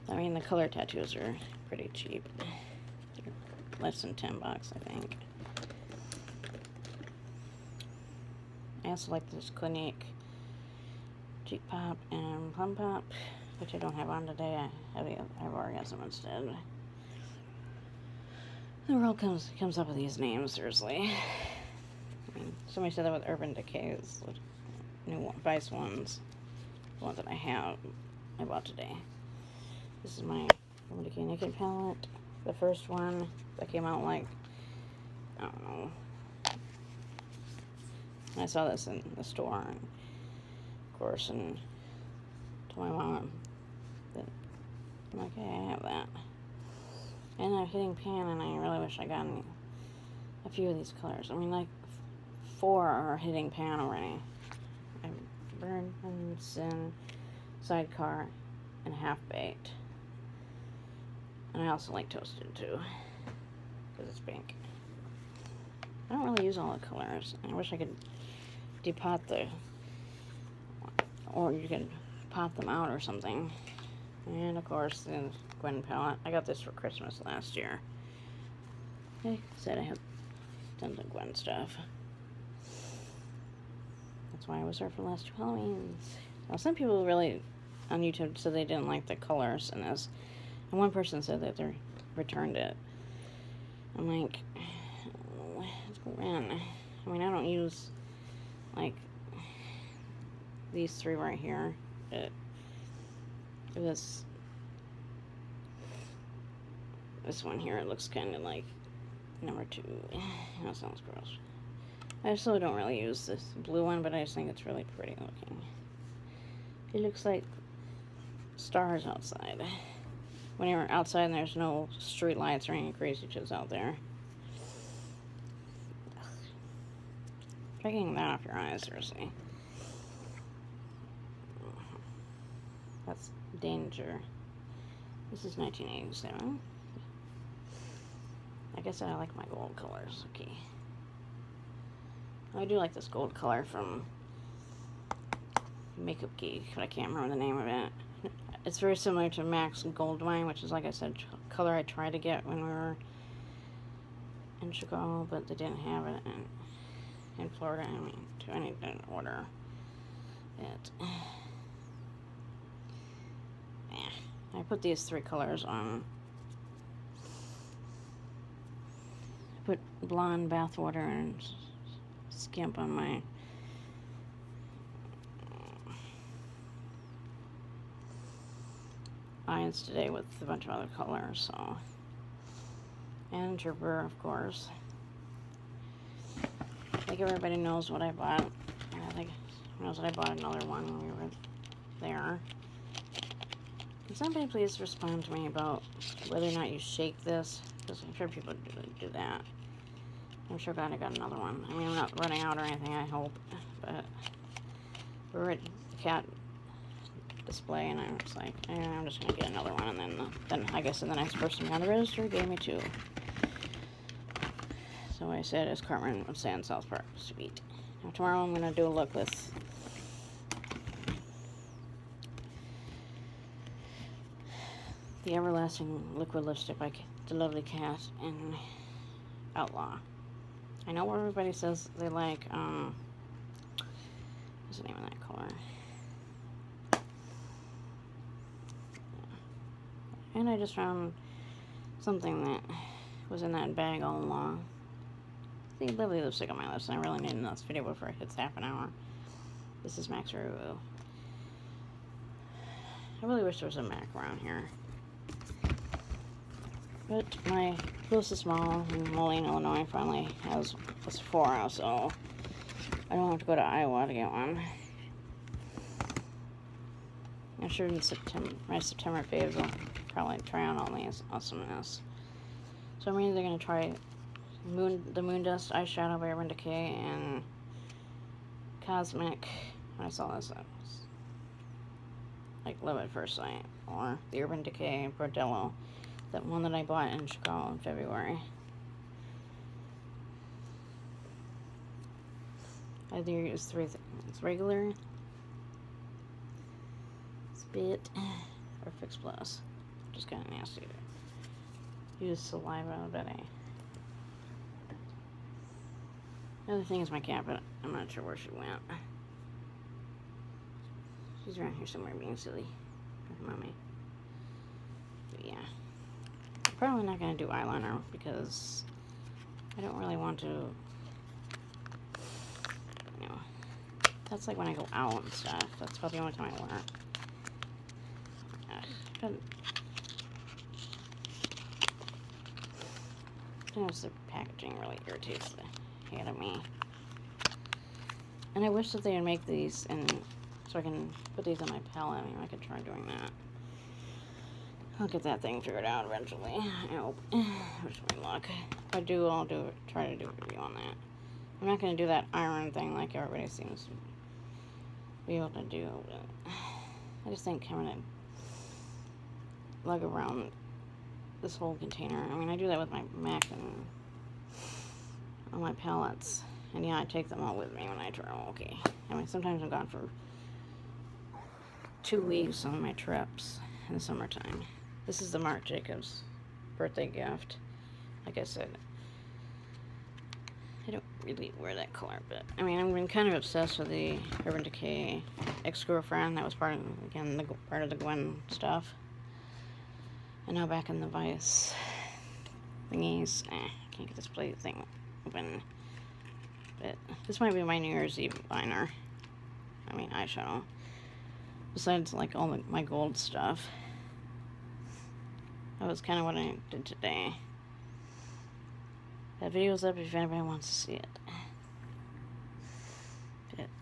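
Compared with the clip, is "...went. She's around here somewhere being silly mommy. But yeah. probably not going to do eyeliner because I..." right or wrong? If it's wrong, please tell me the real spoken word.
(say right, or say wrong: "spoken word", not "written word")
right.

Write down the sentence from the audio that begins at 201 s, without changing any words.
I mean, I'm not running out or anything, I hope.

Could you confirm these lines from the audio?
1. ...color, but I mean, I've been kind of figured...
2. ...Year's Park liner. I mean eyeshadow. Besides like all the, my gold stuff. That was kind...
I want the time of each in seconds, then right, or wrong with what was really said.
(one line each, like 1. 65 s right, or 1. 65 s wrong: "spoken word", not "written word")
1. 381 s wrong: "obsessed", not "figured"
2. 397 s wrong: "Eve", not "Park".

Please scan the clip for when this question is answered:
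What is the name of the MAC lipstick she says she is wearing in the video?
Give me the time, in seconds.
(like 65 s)
250 s.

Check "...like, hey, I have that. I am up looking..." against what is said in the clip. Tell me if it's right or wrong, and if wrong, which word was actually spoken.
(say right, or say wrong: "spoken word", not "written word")
wrong: "hitting", not "looking".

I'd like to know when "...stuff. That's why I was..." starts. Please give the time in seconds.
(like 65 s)
81 s.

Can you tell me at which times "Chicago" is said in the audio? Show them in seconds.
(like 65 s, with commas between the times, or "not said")
154 s, 287 s.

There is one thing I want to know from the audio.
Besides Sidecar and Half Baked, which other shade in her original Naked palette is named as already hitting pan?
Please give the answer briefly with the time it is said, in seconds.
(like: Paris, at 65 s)
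Burns, at 55 s.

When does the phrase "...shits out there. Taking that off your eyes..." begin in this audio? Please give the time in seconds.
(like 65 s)
123 s.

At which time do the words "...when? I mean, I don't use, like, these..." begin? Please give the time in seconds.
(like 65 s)
96 s.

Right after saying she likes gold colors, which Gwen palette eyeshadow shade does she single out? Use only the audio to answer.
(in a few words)
1987.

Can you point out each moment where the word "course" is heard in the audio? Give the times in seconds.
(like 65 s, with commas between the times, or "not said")
40 s, 74 s, 184 s.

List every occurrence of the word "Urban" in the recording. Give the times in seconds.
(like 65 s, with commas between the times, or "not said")
23 s, 276 s, 284 s, 384 s.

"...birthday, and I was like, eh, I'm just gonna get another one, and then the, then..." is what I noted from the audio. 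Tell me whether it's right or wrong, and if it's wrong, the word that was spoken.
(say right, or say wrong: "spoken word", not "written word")
wrong: "display", not "birthday".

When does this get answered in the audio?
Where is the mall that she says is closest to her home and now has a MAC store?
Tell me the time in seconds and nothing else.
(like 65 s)
259 s.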